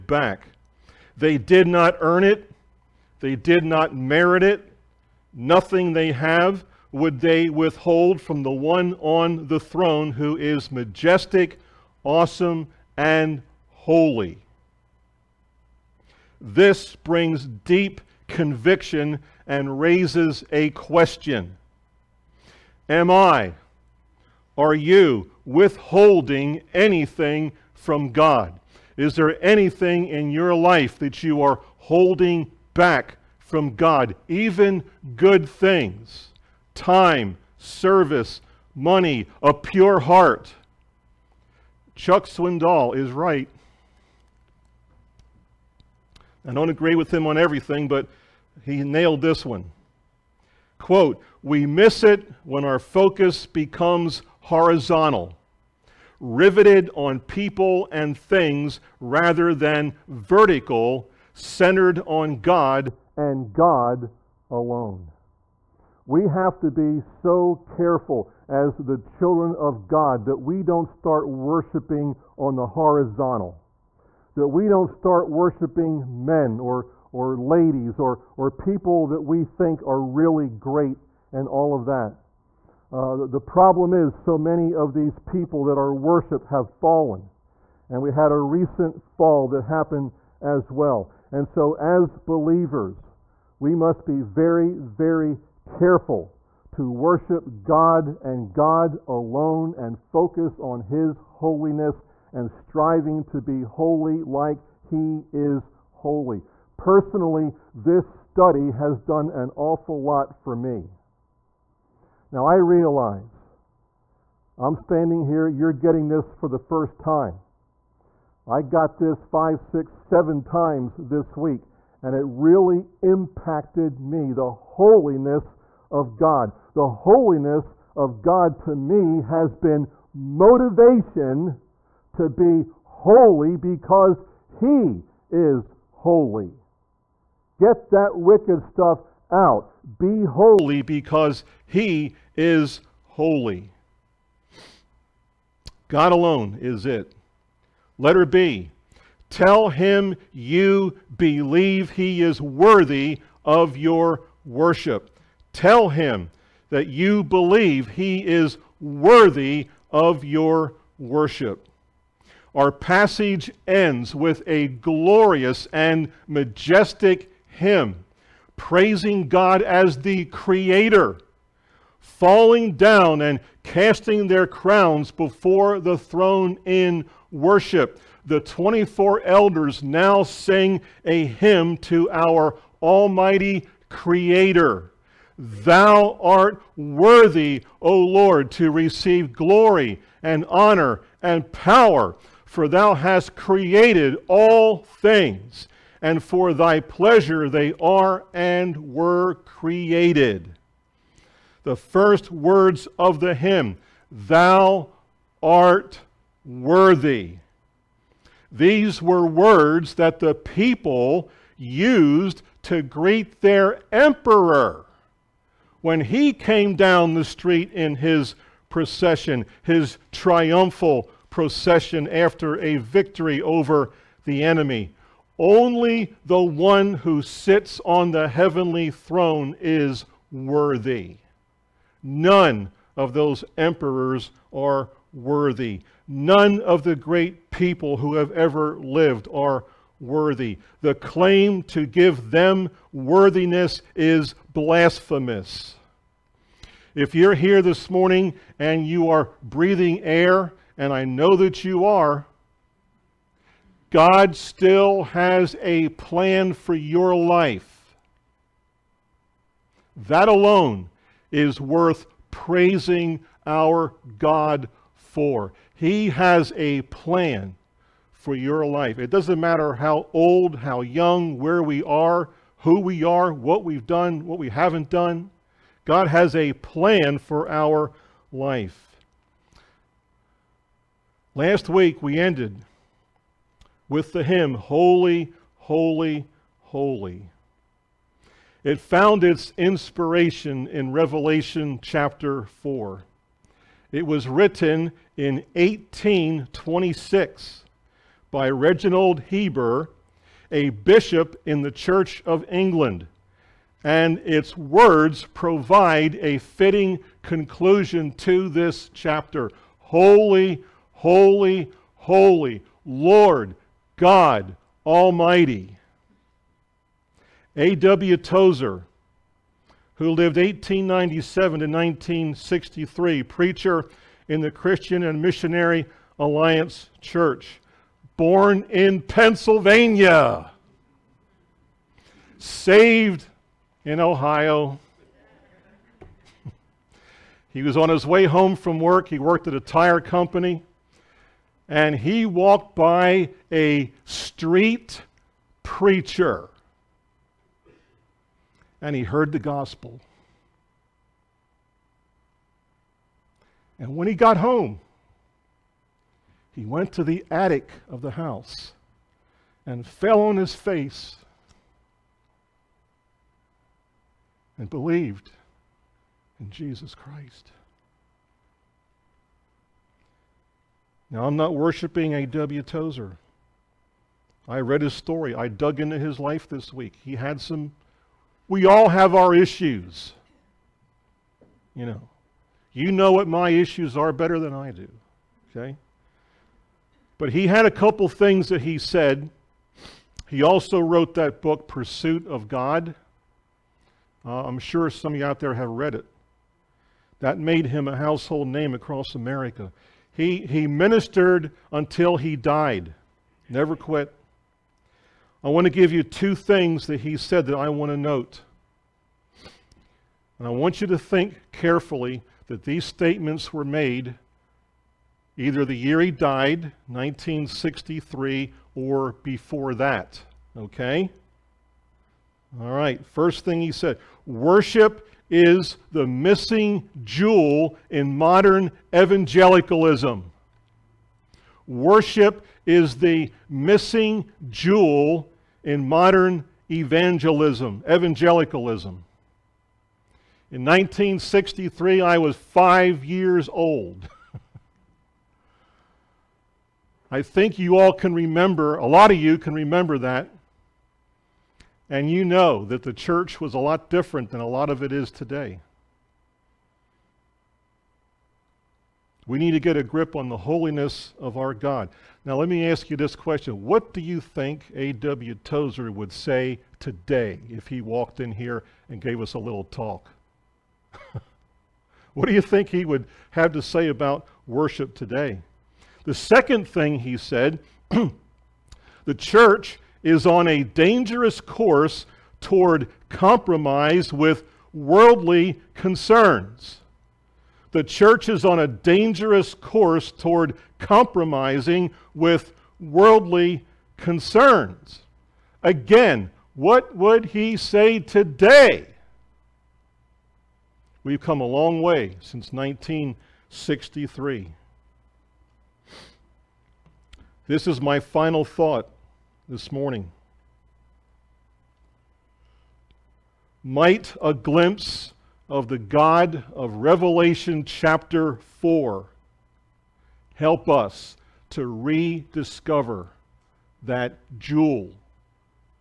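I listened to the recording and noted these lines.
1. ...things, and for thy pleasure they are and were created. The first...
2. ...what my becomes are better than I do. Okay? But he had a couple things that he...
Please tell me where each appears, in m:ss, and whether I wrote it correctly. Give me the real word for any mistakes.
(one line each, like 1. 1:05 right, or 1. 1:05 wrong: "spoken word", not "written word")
1. 3:14 right
2. 6:23 wrong: "issues", not "becomes".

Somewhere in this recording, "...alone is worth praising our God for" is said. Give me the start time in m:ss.
4:20.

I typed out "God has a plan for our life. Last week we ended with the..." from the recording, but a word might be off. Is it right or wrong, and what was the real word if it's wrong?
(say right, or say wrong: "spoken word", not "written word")
right.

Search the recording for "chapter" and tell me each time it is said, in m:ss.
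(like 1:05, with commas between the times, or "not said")
4:51, 5:08, 8:37.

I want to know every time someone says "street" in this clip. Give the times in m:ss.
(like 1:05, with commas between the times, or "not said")
3:37, 5:44.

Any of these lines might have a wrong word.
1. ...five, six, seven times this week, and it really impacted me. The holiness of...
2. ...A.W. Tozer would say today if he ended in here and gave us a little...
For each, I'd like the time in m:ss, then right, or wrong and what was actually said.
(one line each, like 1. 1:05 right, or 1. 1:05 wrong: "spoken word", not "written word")
1. 1:59 right
2. 7:44 wrong: "walked", not "ended".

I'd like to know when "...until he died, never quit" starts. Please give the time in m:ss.
6:41.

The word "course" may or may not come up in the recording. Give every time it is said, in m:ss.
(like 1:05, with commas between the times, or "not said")
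8:01, 8:09.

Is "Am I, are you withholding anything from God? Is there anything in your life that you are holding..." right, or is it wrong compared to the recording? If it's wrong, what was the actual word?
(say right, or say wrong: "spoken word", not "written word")
right.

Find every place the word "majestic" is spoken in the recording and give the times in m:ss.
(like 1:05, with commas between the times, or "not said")
0:10, 2:46.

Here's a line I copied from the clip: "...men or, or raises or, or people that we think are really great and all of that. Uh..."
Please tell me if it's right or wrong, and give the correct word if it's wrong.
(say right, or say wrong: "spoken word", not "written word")
wrong: "ladies", not "raises".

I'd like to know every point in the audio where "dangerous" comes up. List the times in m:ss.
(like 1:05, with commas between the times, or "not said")
8:00, 8:08.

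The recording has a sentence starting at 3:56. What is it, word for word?
None of the great people who have ever lived are worthy.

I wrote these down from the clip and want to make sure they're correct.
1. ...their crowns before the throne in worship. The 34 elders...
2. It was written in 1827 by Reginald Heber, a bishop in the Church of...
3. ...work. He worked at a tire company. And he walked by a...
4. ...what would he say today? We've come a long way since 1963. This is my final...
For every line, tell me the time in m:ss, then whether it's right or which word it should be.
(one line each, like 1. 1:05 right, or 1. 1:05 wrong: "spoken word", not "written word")
1. 2:54 wrong: "24", not "34"
2. 4:53 wrong: "1826", not "1827"
3. 5:38 right
4. 8:16 right.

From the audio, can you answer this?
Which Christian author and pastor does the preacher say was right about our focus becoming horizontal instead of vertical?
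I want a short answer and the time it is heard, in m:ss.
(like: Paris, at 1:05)
Chuck Swindoll, at 0:41.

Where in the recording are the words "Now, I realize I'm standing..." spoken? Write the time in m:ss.
1:52.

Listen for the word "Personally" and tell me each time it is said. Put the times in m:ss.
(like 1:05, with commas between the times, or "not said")
1:46.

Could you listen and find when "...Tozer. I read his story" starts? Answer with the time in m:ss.
6:12.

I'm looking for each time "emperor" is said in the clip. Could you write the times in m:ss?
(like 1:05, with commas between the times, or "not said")
3:33, 3:53.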